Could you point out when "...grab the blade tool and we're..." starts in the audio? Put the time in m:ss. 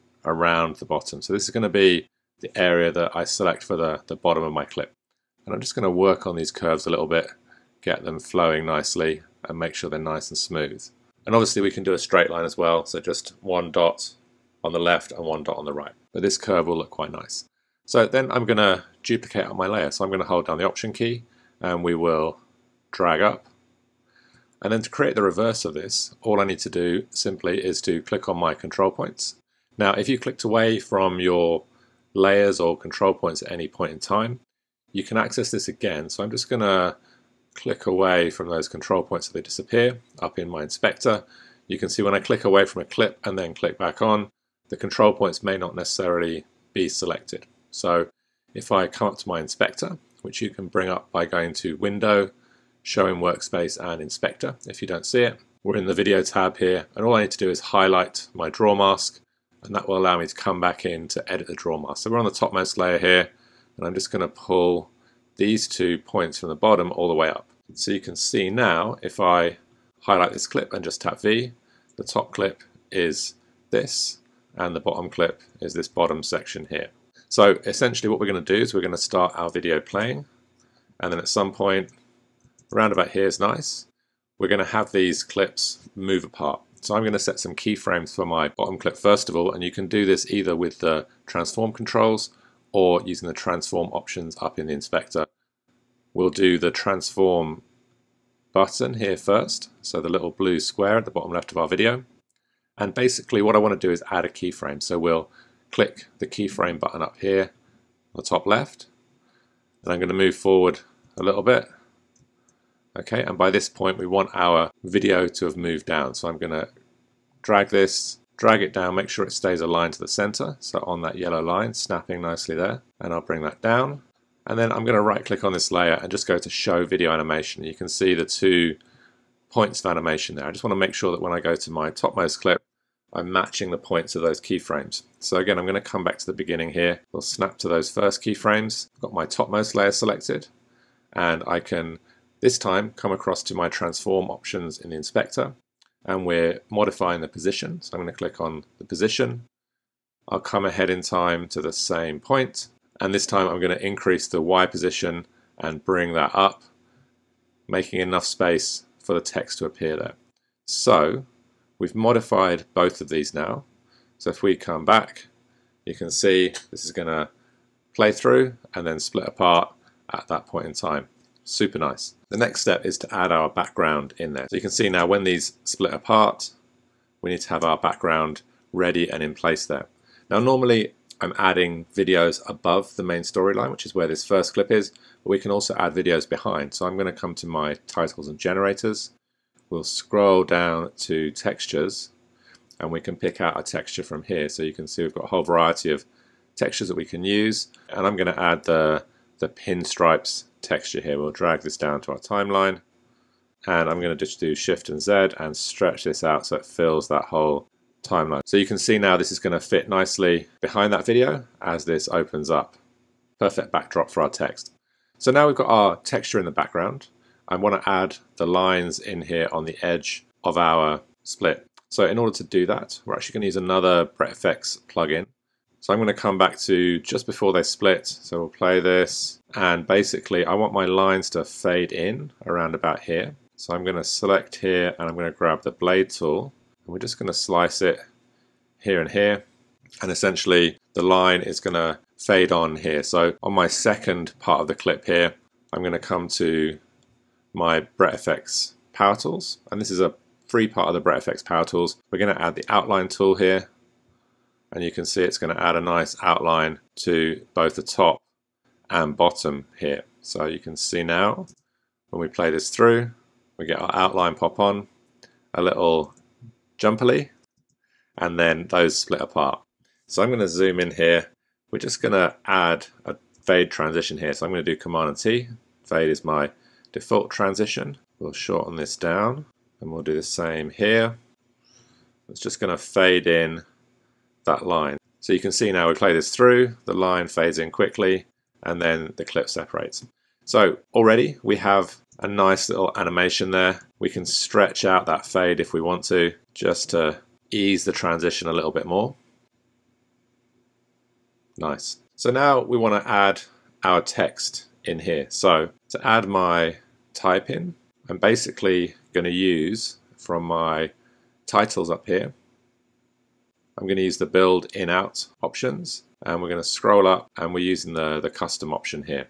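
3:55.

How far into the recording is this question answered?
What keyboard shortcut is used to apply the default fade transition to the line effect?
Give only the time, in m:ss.
4:34.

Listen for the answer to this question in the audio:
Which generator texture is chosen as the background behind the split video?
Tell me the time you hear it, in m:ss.
3:19.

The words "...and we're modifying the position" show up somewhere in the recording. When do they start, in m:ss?
2:26.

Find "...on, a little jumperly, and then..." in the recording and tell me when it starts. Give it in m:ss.
4:24.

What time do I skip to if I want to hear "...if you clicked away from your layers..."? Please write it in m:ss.
0:29.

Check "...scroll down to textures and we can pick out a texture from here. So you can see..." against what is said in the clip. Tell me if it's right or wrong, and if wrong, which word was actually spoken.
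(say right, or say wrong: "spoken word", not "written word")
right.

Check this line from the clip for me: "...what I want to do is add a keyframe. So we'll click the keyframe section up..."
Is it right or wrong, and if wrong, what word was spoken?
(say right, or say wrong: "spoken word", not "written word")
wrong: "button", not "section".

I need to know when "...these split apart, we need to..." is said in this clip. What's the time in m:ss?
2:55.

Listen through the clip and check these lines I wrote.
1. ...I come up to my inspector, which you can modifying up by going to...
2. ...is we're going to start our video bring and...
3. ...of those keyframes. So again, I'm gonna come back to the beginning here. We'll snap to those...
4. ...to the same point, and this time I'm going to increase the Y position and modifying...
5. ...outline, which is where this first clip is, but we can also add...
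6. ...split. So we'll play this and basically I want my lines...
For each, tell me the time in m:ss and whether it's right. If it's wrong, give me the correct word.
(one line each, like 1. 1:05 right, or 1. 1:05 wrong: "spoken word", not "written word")
1. 0:48 wrong: "bring", not "modifying"
2. 1:18 wrong: "playing", not "bring"
3. 2:14 right
4. 2:31 wrong: "bring", not "modifying"
5. 3:03 wrong: "storyline", not "outline"
6. 3:47 right.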